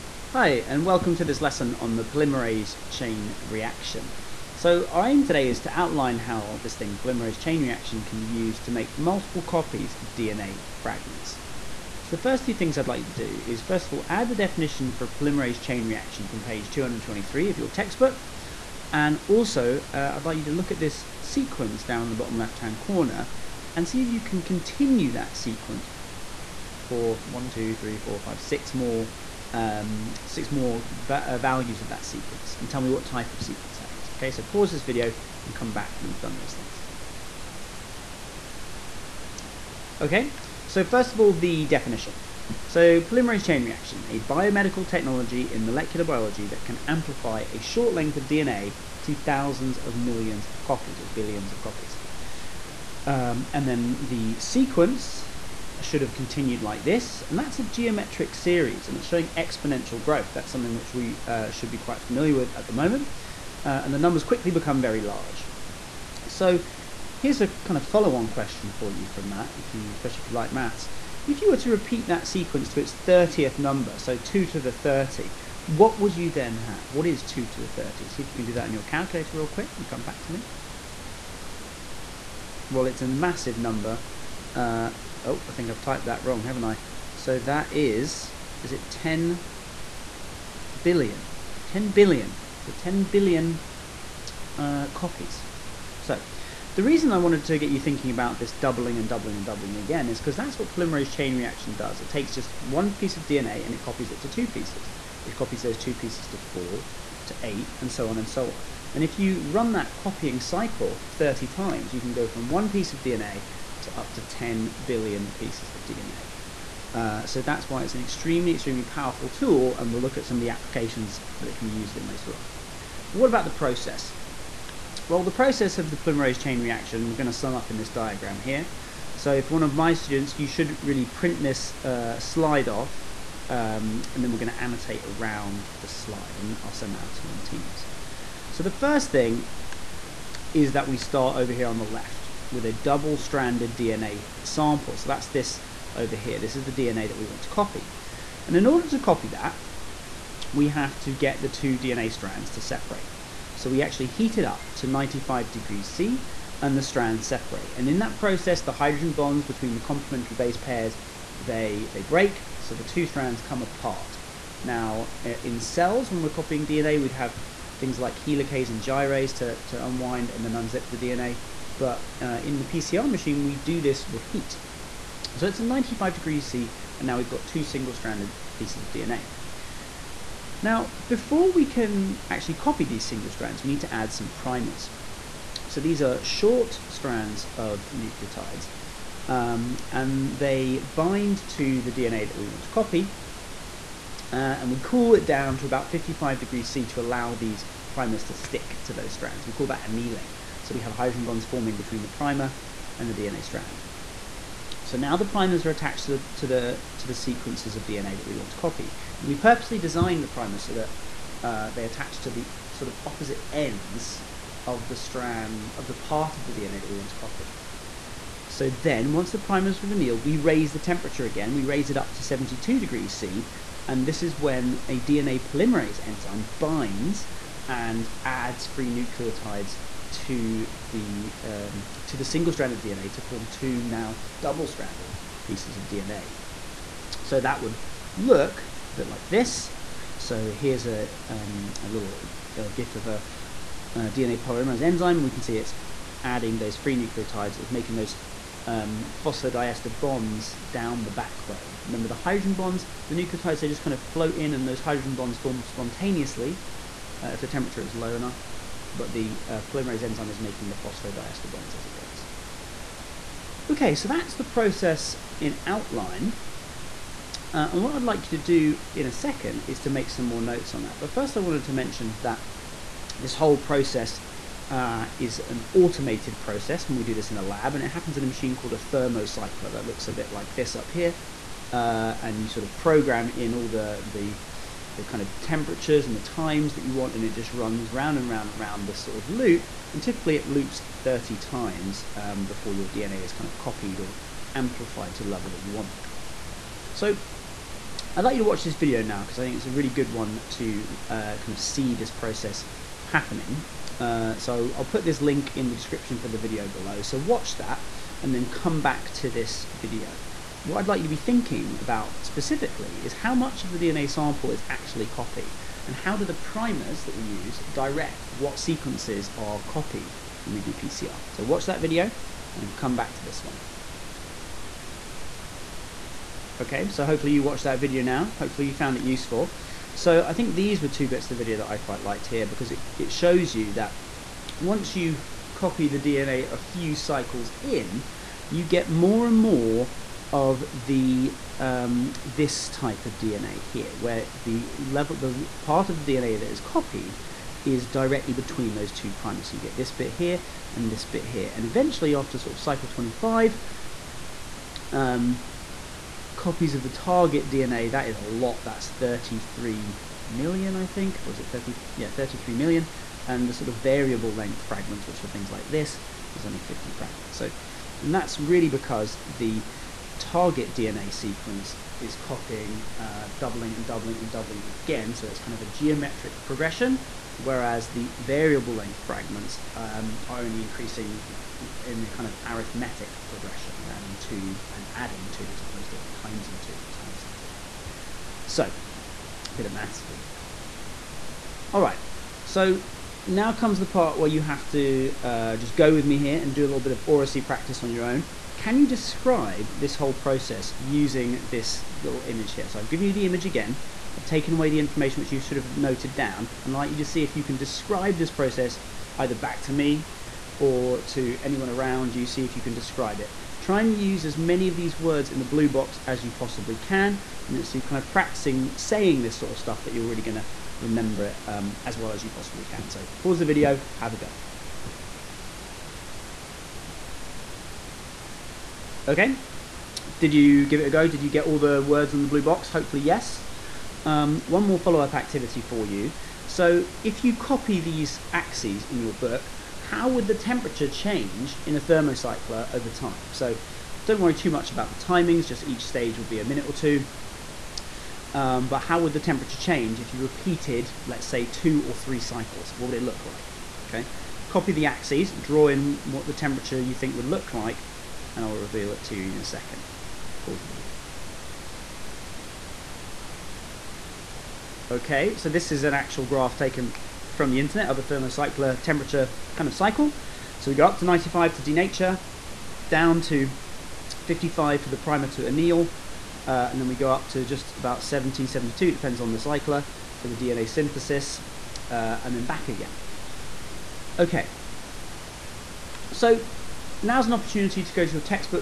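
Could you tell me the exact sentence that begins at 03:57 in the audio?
So that would look a bit like this.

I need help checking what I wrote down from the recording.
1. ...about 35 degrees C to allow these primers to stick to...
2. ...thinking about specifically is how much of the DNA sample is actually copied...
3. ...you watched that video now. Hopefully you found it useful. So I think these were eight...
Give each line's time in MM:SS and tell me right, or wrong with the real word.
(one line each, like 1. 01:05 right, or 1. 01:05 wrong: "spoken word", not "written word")
1. 03:15 wrong: "55", not "35"
2. 05:11 right
3. 05:27 wrong: "two", not "eight".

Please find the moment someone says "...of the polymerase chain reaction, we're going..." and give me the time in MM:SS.
02:05.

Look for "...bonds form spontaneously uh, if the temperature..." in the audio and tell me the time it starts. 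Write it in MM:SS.
04:15.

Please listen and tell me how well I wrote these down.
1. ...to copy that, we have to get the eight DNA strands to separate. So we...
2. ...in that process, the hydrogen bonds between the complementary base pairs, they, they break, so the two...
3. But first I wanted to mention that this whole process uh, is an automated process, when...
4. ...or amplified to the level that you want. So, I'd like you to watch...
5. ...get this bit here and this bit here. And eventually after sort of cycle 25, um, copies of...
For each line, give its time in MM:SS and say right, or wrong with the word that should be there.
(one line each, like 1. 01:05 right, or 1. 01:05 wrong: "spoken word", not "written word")
1. 02:28 wrong: "two", not "eight"
2. 02:37 right
3. 04:30 right
4. 04:54 right
5. 05:49 right.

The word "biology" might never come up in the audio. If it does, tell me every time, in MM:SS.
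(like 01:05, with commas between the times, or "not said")
00:46.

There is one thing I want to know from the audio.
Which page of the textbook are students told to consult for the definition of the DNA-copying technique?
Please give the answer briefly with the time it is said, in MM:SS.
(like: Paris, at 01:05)
223, at 00:16.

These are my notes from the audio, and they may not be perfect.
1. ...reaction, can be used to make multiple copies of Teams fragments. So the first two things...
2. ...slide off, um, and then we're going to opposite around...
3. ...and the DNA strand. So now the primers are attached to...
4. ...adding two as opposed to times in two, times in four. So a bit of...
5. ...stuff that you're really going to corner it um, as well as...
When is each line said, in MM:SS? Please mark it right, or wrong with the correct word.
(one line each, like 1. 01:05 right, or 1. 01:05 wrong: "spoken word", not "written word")
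1. 00:07 wrong: "DNA", not "Teams"
2. 02:12 wrong: "annotate", not "opposite"
3. 03:22 right
4. 06:24 wrong: "two", not "four"
5. 06:59 wrong: "remember", not "corner".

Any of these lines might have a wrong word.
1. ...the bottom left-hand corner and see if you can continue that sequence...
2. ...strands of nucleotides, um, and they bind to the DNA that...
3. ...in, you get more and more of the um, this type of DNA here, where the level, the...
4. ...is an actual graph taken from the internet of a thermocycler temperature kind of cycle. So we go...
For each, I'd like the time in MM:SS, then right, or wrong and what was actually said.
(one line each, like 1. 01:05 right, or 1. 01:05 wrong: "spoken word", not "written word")
1. 00:22 right
2. 03:06 right
3. 05:37 right
4. 07:45 right.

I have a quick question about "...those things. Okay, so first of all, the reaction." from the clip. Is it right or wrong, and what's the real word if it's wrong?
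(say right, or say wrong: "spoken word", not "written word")
wrong: "definition", not "reaction".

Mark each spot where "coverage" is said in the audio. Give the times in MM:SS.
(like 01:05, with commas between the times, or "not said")
not said.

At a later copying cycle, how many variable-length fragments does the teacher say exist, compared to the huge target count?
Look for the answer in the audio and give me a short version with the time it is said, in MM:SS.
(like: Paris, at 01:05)
50, at 06:06.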